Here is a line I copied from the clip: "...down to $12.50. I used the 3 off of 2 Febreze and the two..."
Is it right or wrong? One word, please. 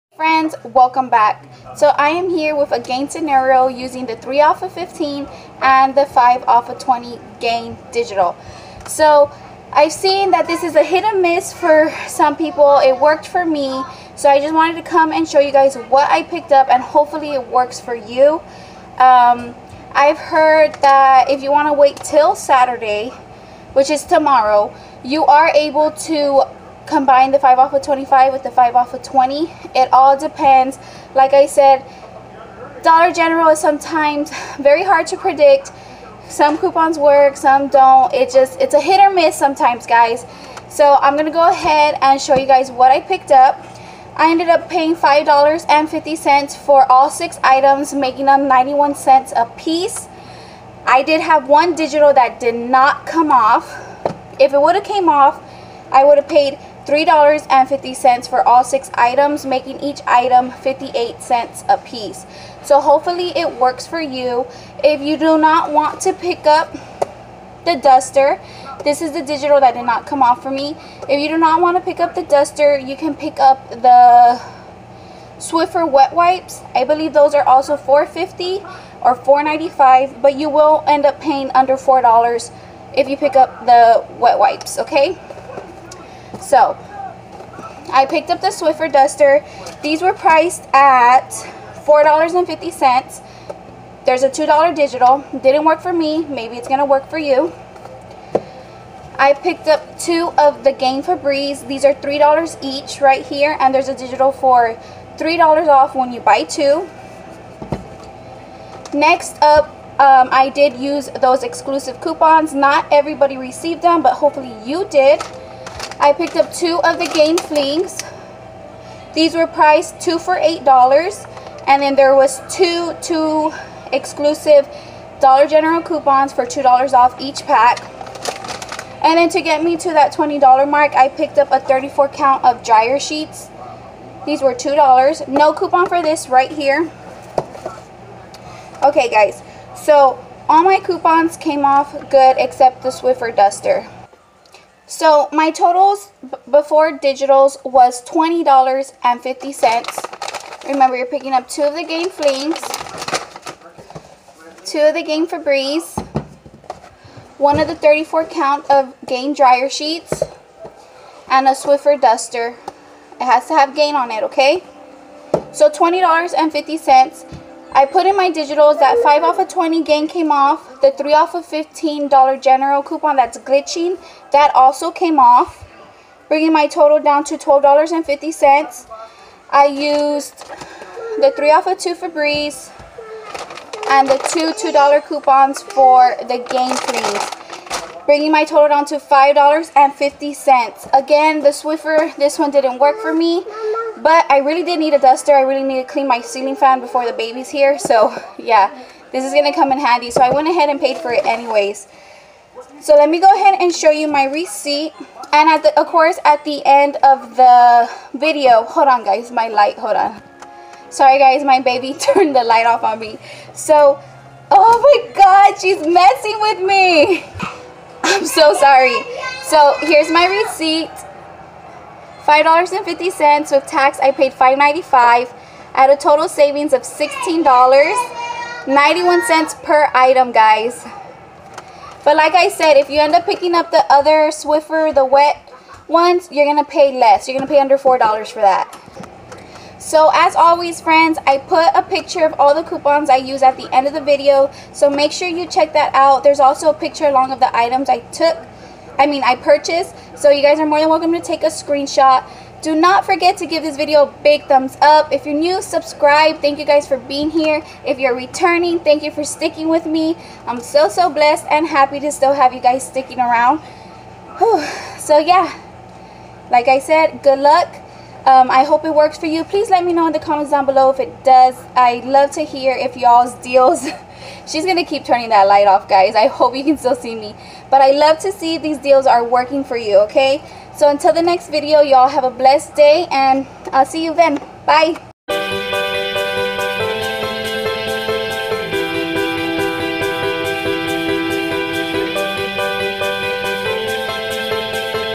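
right.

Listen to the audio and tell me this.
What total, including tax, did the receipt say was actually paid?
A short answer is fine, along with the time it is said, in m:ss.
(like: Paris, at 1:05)
$5.95, at 3:44.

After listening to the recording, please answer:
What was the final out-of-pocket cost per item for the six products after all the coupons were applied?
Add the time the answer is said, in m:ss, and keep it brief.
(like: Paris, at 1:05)
91 cents, at 0:48.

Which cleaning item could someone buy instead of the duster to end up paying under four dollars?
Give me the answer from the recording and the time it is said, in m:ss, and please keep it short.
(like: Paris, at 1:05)
Swiffer wet wipes, at 1:15.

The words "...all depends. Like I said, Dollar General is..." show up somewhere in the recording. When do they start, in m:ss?
0:29.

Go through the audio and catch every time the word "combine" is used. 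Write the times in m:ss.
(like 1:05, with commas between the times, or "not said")
0:26.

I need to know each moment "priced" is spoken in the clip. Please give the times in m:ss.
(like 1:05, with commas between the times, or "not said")
1:30, 1:59.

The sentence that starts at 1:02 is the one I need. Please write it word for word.
So hopefully it works for you.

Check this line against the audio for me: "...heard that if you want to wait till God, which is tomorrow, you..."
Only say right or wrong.
wrong.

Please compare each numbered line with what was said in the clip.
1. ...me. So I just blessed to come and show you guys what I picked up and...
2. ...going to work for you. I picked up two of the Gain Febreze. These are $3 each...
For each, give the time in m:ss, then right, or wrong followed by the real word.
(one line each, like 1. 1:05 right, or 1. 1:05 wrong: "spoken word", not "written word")
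1. 0:13 wrong: "wanted", not "blessed"
2. 1:36 right.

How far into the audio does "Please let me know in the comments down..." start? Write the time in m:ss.
4:29.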